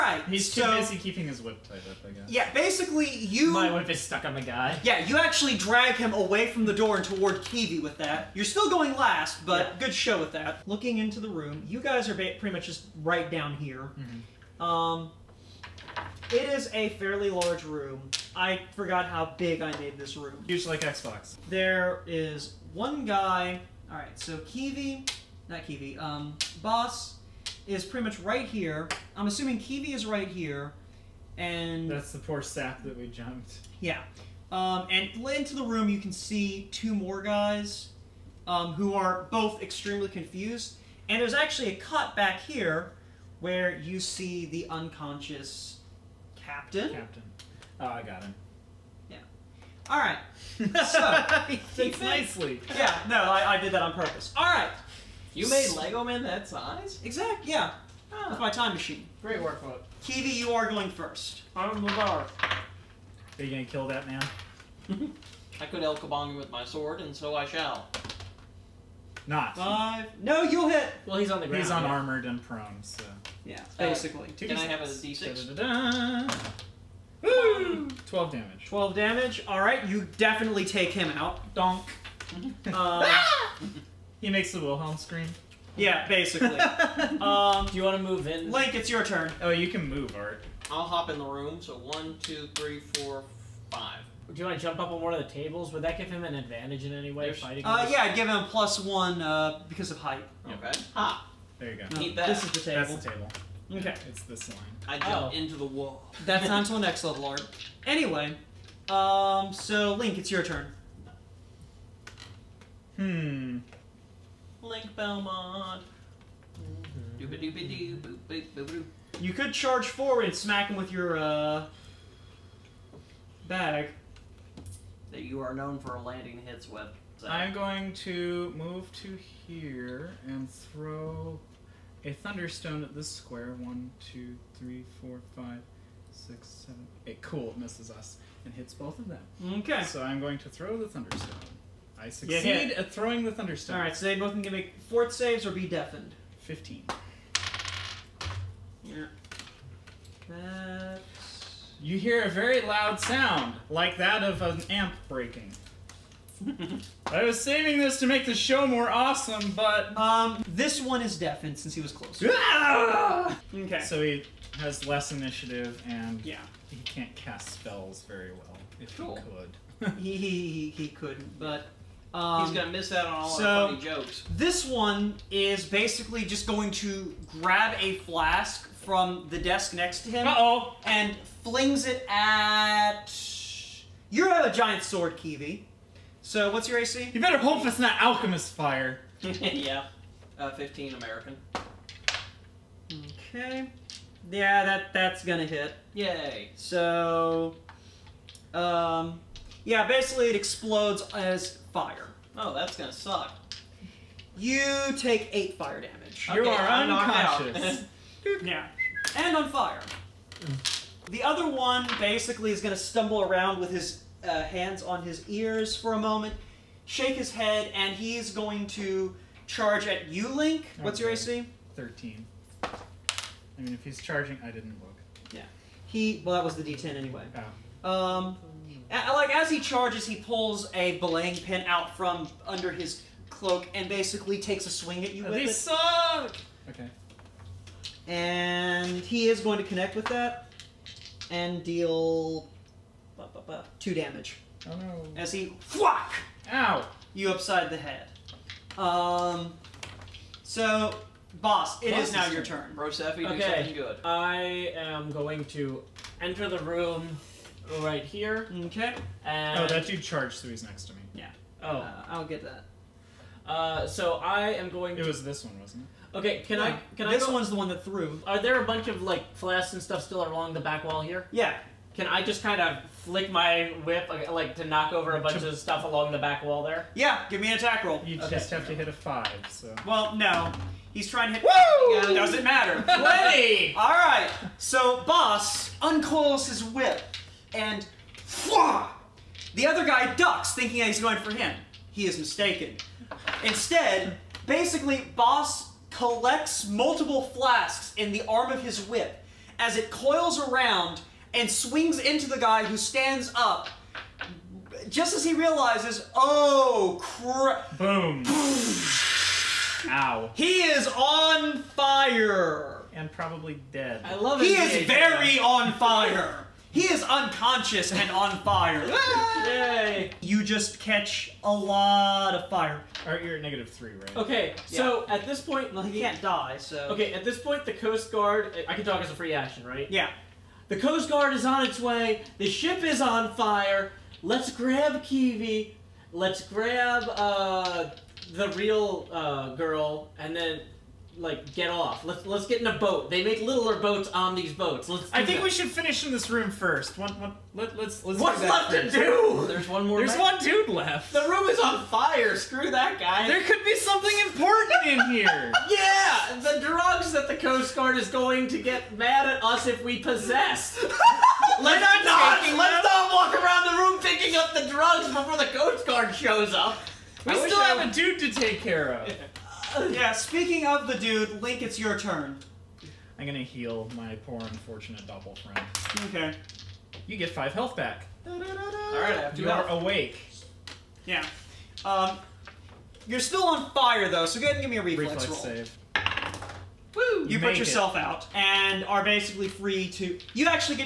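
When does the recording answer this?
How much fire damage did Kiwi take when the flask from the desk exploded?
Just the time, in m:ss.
3:25.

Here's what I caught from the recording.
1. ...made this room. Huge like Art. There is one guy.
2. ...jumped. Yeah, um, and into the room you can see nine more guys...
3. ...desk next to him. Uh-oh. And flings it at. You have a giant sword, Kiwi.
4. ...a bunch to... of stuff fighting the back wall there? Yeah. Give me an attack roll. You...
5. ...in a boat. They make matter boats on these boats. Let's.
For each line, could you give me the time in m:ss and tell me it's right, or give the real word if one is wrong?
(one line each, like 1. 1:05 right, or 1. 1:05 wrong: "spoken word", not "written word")
1. 0:19 wrong: "Xbox", not "Art"
2. 0:33 wrong: "two", not "nine"
3. 2:59 right
4. 4:35 wrong: "along", not "fighting"
5. 5:42 wrong: "littler", not "matter".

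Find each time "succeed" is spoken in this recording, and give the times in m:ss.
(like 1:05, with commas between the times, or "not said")
2:22.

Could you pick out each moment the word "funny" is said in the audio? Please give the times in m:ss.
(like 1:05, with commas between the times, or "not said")
2:53.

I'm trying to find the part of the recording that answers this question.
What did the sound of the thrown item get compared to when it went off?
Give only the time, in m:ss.
2:34.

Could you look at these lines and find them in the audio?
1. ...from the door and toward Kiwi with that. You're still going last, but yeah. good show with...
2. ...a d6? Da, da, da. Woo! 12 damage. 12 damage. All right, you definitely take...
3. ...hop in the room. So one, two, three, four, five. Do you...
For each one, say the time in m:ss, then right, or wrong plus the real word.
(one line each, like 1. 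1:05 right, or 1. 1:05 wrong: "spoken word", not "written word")
1. 0:06 right
2. 1:14 right
3. 1:30 right.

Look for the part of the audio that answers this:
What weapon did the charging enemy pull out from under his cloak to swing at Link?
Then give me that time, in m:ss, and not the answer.
3:50.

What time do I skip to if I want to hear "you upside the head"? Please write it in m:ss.
4:07.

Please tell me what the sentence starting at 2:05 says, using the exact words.
That you are known for landing hits with.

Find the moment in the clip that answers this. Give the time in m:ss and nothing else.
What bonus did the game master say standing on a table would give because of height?
1:38.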